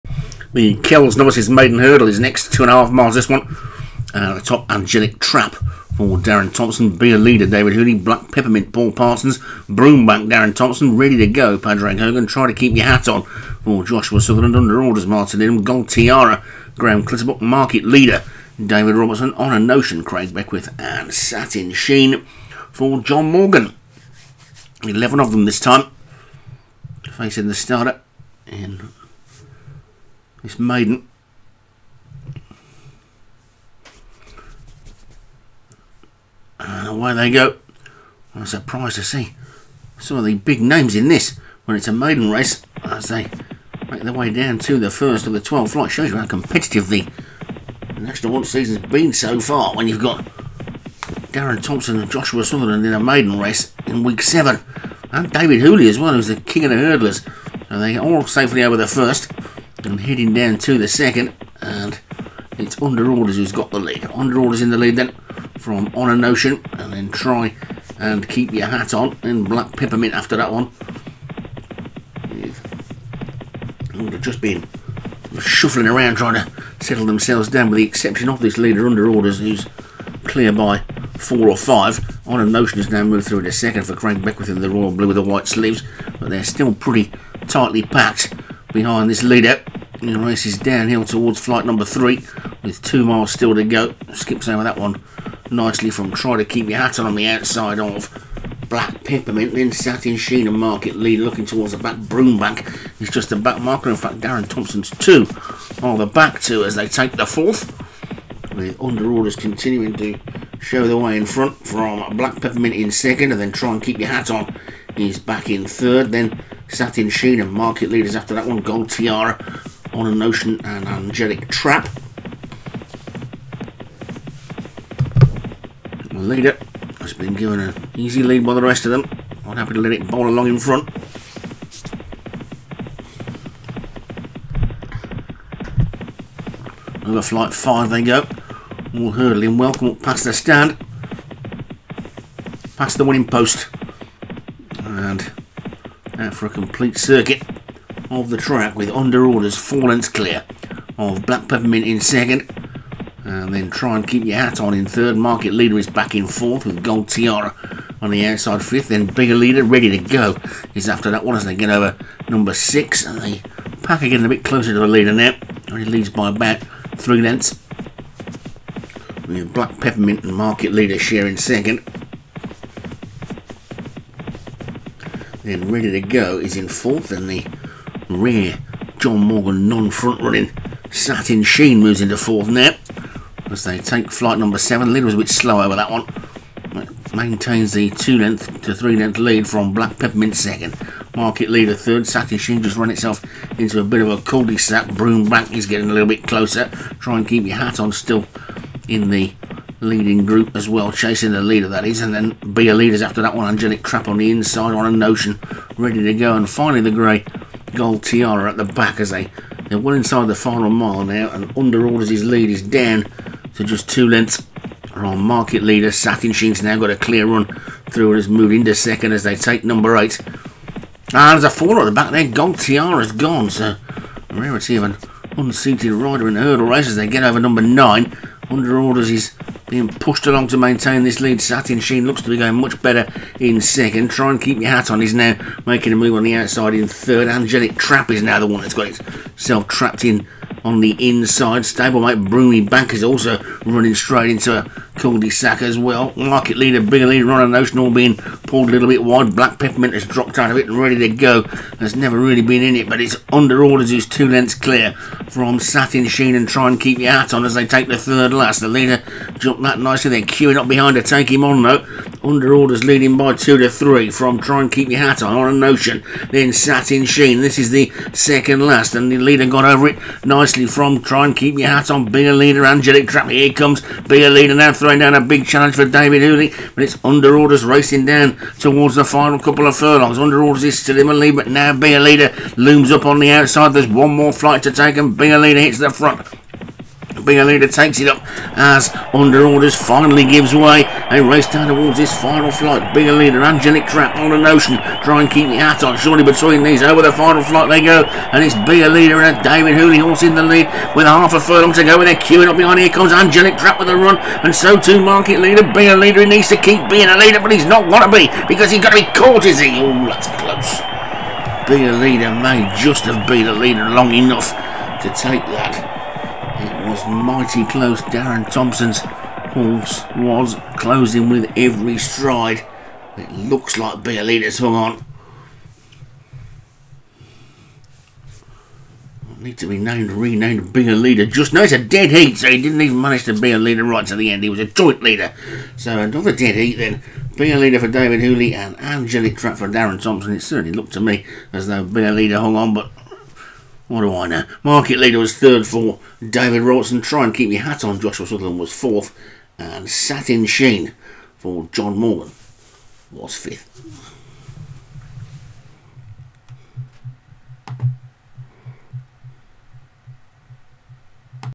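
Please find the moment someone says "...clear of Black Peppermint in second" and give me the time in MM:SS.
02:30.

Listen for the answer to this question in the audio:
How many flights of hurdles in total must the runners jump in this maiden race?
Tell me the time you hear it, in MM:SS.
00:45.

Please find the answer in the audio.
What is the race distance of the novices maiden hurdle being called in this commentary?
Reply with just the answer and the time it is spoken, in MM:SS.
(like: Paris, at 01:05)
2.5 miles, at 00:02.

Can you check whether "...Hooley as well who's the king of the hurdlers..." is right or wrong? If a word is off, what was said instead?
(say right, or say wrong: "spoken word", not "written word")
right.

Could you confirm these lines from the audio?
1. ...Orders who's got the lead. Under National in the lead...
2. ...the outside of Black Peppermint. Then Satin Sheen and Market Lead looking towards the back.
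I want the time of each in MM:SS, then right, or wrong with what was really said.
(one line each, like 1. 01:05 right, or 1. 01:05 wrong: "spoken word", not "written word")
1. 01:03 wrong: "Orders", not "National"
2. 01:37 right.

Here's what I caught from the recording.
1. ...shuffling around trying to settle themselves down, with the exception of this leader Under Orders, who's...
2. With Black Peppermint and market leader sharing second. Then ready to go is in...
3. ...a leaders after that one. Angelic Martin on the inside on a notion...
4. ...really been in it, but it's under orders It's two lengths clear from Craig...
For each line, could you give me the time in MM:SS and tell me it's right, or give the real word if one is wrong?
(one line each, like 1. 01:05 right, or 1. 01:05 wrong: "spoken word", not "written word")
1. 01:15 right
2. 02:49 right
3. 03:22 wrong: "Trap", not "Martin"
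4. 04:12 wrong: "Satin", not "Craig".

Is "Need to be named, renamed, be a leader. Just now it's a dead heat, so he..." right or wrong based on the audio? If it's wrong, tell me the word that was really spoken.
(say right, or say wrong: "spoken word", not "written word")
right.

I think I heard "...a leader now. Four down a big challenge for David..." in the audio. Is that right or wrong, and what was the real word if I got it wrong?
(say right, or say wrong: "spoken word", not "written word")
wrong: "Three", not "Four".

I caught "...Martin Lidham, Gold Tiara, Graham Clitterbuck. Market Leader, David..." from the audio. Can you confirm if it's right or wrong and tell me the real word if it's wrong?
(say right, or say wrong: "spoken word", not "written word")
right.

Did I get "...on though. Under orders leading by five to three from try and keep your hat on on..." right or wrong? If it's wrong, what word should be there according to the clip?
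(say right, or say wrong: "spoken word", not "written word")
wrong: "two", not "five".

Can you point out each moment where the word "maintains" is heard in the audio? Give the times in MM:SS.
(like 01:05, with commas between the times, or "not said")
03:07, 03:50.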